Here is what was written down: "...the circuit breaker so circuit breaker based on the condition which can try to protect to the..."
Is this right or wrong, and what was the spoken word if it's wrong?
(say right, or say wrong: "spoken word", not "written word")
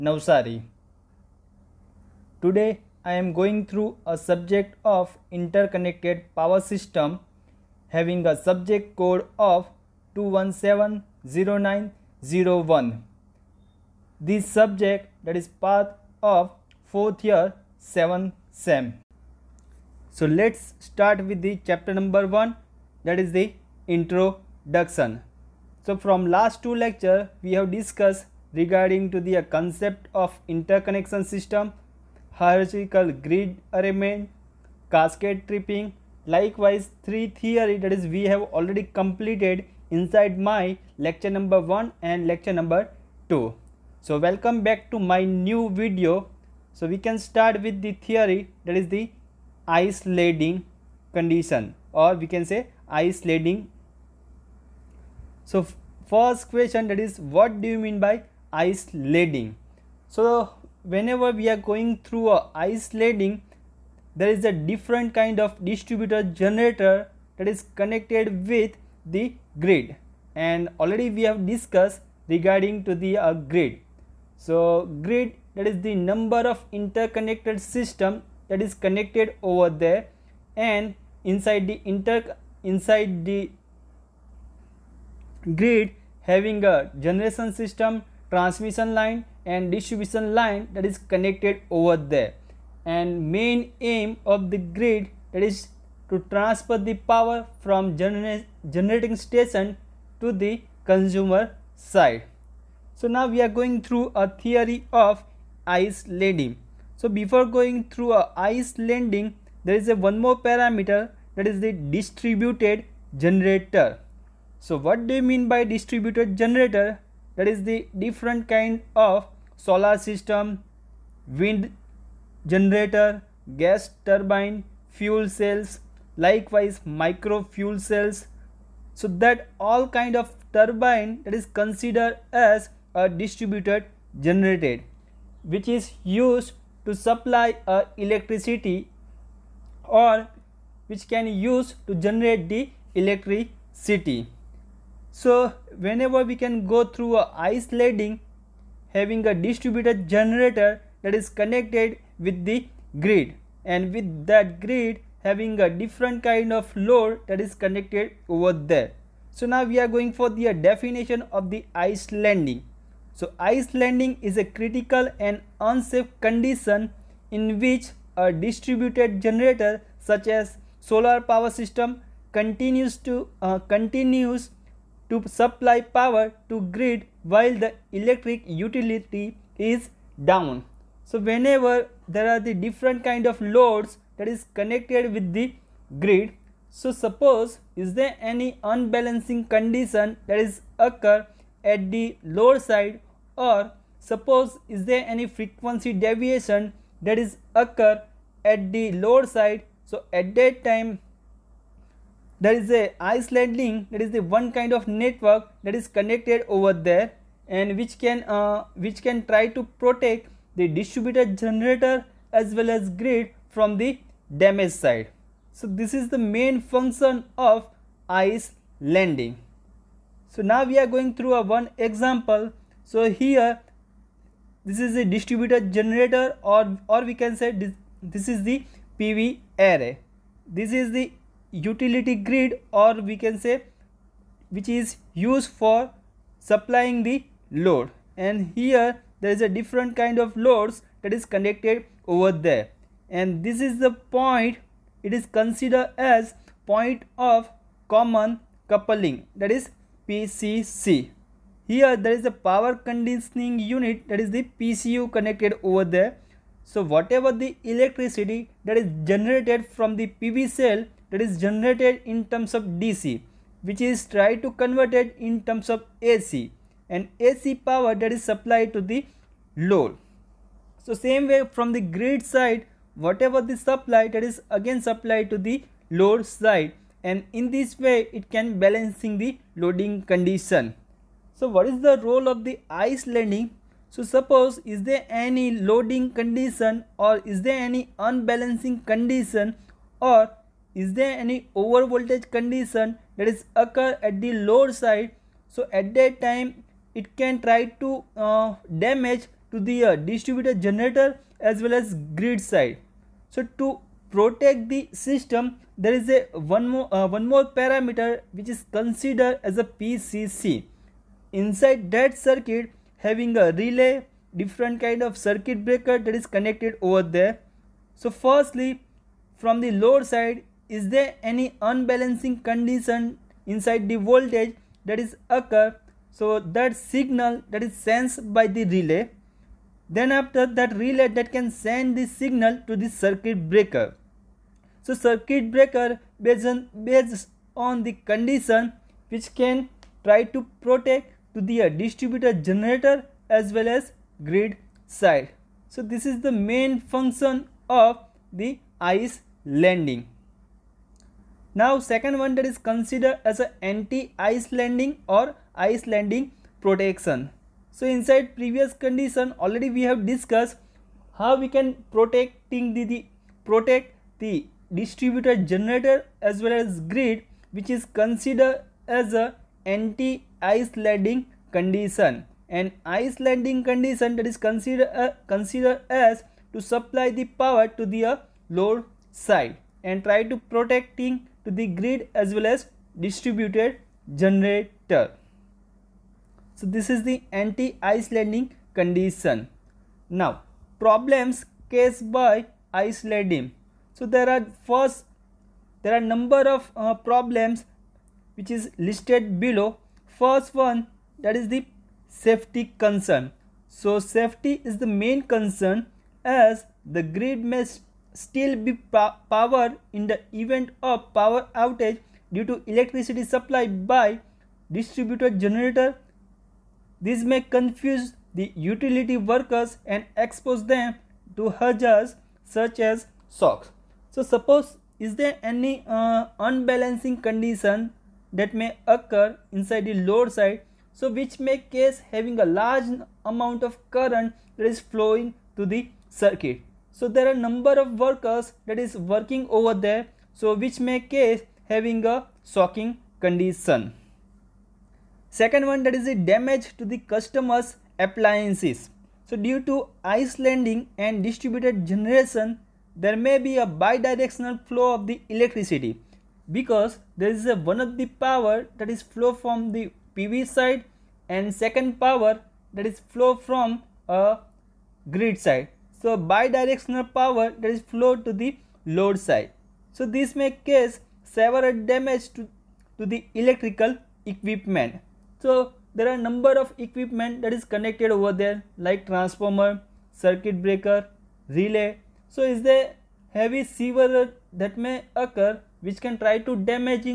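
right.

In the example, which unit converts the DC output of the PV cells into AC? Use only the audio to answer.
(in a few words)
power conditioning unit.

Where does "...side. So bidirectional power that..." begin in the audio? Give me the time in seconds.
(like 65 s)
465 s.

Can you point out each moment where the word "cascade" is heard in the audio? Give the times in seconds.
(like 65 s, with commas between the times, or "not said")
34 s.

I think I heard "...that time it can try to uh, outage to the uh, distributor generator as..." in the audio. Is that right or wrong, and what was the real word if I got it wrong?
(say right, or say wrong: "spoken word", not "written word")
wrong: "damage", not "outage".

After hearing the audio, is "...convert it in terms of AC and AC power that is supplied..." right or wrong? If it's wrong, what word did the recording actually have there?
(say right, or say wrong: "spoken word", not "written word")
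right.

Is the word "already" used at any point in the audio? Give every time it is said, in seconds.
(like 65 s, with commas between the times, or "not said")
38 s, 70 s, 359 s.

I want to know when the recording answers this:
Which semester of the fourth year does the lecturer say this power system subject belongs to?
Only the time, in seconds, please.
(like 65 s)
17 s.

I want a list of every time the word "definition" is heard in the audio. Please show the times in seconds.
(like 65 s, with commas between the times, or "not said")
160 s.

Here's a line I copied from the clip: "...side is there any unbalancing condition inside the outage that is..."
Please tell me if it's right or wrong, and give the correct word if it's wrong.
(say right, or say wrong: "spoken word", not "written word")
wrong: "voltage", not "outage".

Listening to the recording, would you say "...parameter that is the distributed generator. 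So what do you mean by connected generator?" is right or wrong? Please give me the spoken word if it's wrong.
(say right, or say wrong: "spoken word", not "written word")
wrong: "distributed", not "connected".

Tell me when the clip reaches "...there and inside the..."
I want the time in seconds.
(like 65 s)
79 s.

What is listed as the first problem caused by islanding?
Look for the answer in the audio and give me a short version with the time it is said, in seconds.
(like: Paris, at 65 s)
safety concern, at 402 s.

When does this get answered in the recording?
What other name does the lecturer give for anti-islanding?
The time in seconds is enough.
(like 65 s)
355 s.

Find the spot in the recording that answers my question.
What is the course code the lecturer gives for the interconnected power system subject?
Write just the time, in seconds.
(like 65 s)
10 s.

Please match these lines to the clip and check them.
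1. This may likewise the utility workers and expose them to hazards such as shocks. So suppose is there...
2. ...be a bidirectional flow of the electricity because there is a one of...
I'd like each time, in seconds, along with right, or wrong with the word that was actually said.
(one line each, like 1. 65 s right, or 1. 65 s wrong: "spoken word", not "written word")
1. 417 s wrong: "confuse", not "likewise"
2. 453 s right.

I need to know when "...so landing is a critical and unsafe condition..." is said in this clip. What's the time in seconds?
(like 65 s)
163 s.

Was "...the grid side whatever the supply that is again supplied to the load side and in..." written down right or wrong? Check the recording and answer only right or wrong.
right.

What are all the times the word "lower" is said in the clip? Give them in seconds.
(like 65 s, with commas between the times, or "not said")
192 s, 198 s.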